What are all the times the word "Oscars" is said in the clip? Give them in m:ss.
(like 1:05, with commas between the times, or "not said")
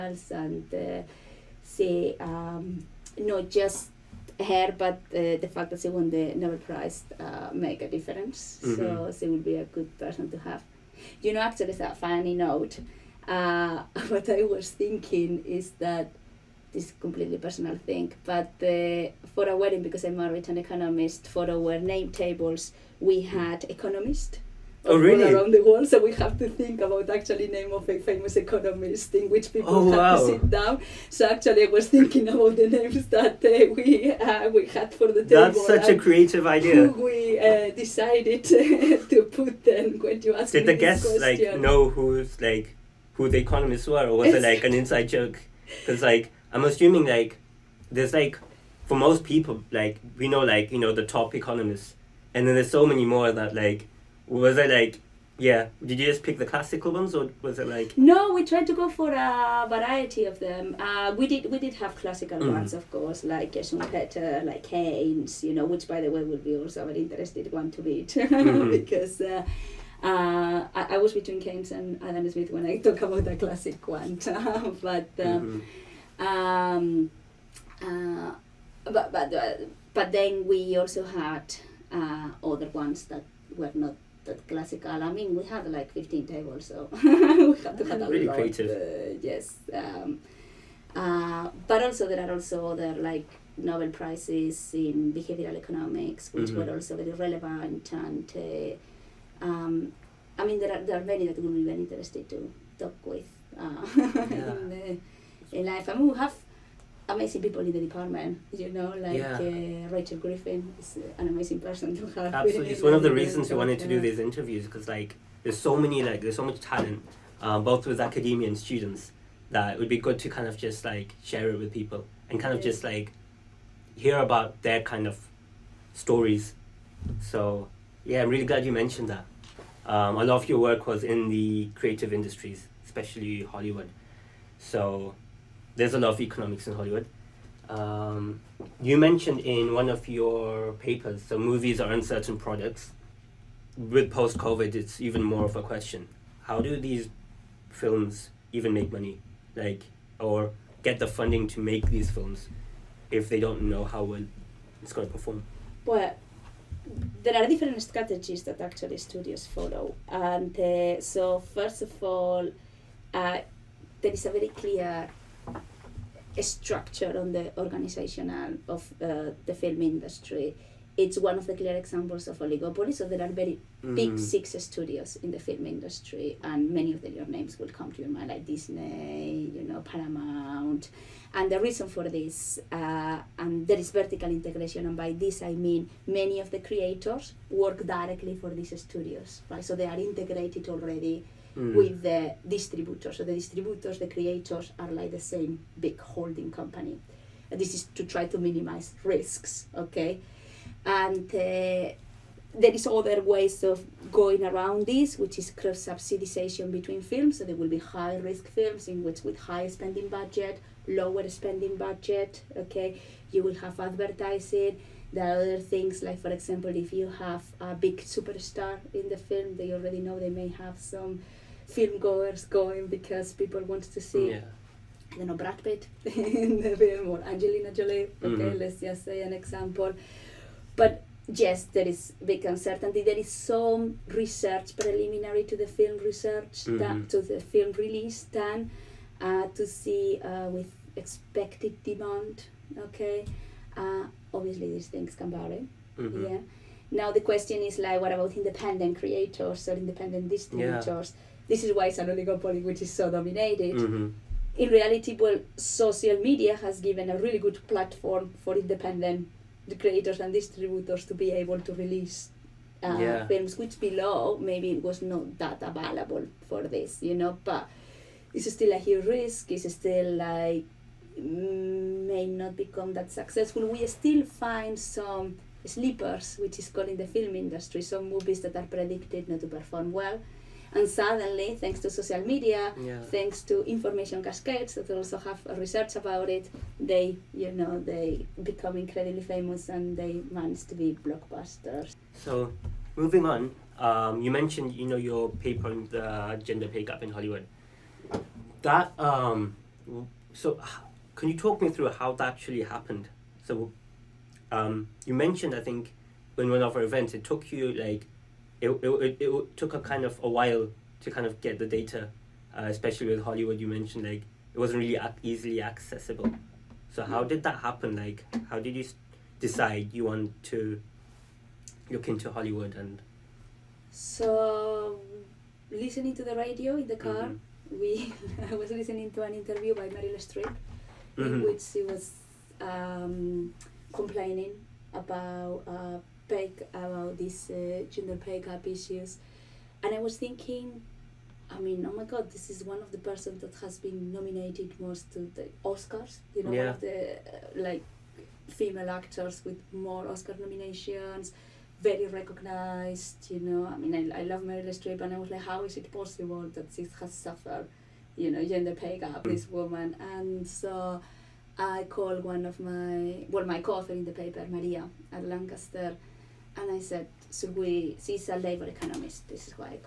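5:45, 5:50.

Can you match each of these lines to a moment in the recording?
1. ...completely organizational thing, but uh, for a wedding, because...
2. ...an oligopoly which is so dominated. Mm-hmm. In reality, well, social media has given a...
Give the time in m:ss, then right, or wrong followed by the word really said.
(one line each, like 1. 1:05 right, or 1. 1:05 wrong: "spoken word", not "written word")
1. 0:17 wrong: "personal", not "organizational"
2. 4:11 right.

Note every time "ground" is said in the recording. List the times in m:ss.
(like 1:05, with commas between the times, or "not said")
not said.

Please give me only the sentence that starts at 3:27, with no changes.
So there will be high risk films in which with high spending budget, lower spending budget.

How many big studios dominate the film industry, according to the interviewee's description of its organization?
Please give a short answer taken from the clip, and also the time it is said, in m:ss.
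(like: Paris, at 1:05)
Six, at 2:54.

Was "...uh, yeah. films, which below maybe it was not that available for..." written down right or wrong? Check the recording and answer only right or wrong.
right.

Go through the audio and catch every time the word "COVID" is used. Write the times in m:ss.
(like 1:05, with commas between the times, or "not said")
2:24.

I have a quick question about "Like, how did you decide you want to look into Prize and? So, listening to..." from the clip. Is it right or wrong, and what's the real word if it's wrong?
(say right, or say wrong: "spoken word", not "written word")
wrong: "Hollywood", not "Prize".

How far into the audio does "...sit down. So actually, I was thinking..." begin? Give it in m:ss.
0:30.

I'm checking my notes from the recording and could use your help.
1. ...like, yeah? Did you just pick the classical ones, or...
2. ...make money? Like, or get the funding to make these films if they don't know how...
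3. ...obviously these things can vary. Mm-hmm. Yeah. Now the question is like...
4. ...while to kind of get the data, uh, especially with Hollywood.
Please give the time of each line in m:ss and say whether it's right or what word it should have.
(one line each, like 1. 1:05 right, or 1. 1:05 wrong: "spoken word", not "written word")
1. 0:54 right
2. 2:28 right
3. 4:04 right
4. 5:10 right.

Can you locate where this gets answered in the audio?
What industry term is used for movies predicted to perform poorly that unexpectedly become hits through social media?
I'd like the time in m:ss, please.
4:35.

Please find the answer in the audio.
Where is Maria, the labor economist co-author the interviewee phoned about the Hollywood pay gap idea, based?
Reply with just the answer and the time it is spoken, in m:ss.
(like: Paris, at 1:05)
Lancaster, at 6:05.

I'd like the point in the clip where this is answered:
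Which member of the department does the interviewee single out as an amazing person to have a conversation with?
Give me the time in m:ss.
1:49.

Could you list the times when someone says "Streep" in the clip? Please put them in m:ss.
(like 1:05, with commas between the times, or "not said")
5:30, 5:54.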